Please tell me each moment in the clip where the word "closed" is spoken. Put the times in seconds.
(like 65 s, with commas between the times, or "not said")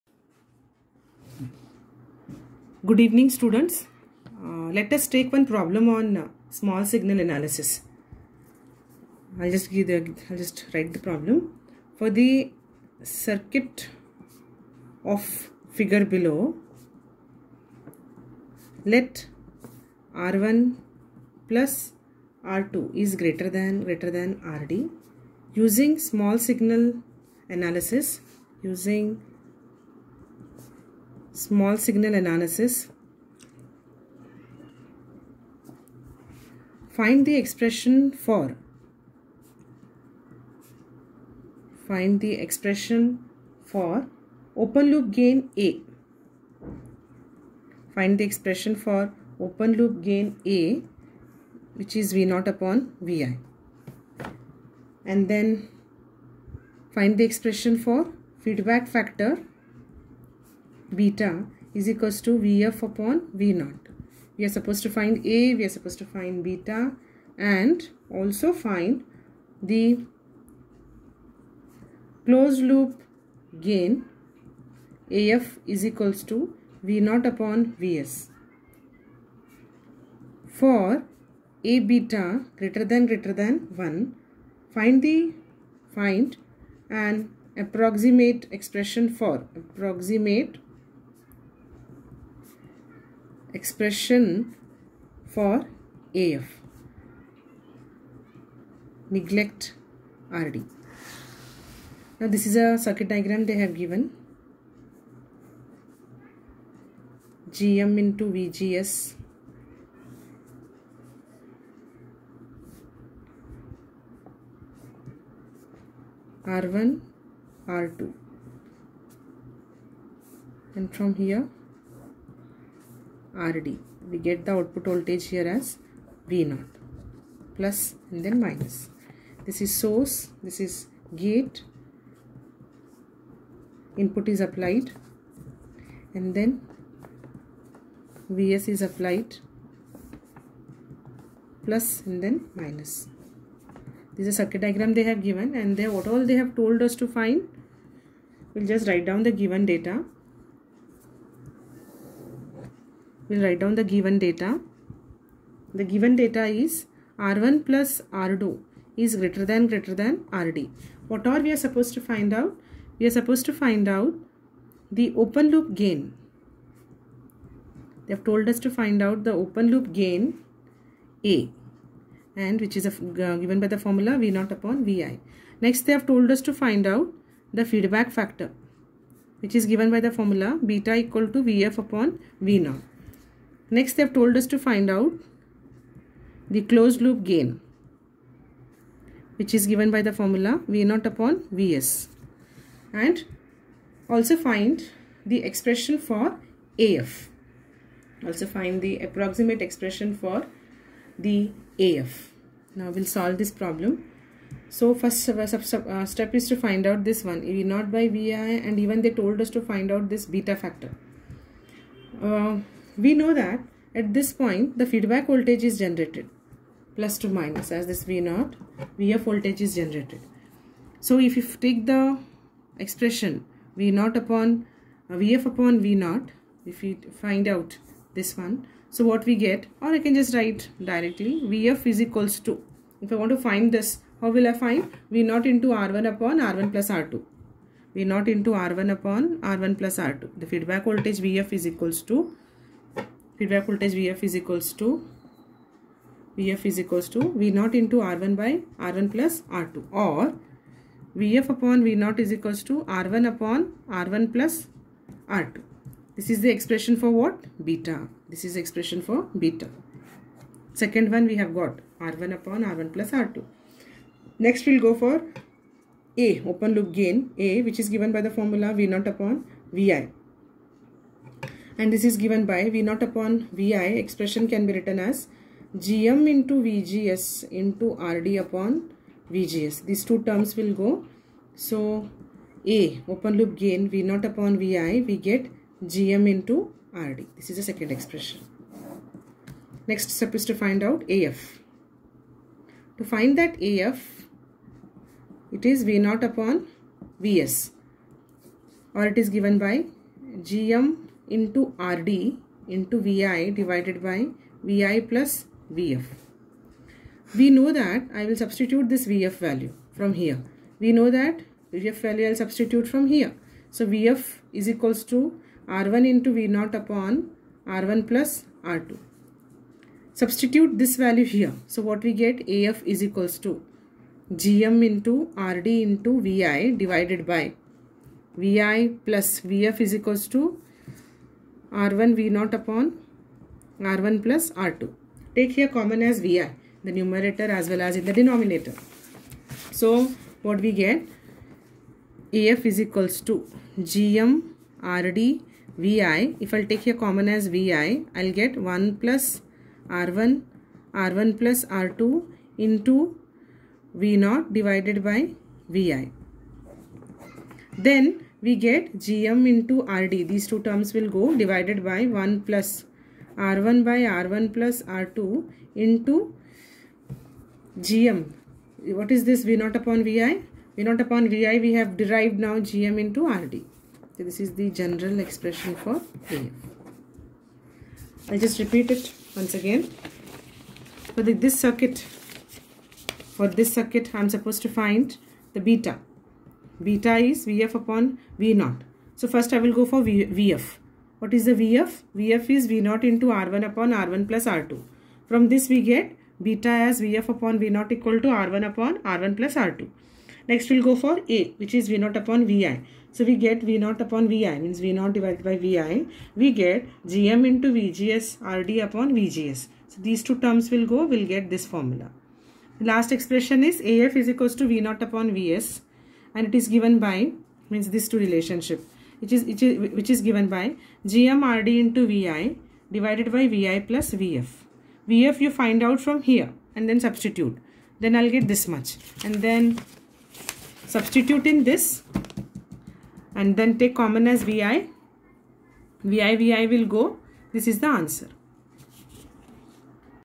72 s, 186 s.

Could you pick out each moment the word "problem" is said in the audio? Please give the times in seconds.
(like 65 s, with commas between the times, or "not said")
5 s, 10 s, 203 s.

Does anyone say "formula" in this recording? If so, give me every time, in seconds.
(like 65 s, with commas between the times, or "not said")
173 s, 180 s, 190 s, 268 s, 411 s.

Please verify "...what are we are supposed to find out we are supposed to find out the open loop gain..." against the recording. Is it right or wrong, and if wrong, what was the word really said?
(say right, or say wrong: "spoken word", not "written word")
right.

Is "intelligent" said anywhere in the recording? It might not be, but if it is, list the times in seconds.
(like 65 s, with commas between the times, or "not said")
not said.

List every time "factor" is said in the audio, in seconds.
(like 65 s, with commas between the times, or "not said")
58 s, 178 s, 210 s.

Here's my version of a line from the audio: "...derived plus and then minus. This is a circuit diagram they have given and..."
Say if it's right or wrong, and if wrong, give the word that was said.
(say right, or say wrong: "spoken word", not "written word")
wrong: "applied", not "derived".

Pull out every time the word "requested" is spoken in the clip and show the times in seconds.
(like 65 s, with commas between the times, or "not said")
not said.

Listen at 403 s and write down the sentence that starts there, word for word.
So we get V0 upon Vi means V0 divided by Vi.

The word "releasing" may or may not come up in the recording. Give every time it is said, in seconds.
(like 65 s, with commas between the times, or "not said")
not said.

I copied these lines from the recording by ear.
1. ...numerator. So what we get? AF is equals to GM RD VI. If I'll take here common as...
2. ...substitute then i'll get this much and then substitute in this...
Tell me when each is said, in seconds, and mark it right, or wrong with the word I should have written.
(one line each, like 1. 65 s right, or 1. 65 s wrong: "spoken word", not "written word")
1. 338 s wrong: "denominator", not "numerator"
2. 427 s right.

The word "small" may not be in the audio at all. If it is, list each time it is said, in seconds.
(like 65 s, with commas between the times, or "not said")
6 s, 25 s, 31 s.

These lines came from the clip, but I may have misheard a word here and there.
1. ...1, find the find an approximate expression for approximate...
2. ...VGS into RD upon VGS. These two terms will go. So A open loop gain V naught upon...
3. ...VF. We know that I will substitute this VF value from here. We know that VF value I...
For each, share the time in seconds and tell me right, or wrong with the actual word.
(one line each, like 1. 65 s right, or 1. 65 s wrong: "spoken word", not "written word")
1. 83 s right
2. 276 s right
3. 305 s right.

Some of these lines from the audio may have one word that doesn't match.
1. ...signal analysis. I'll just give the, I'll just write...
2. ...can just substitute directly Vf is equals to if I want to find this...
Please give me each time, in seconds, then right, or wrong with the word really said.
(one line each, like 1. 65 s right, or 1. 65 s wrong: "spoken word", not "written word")
1. 6 s right
2. 229 s wrong: "write", not "substitute".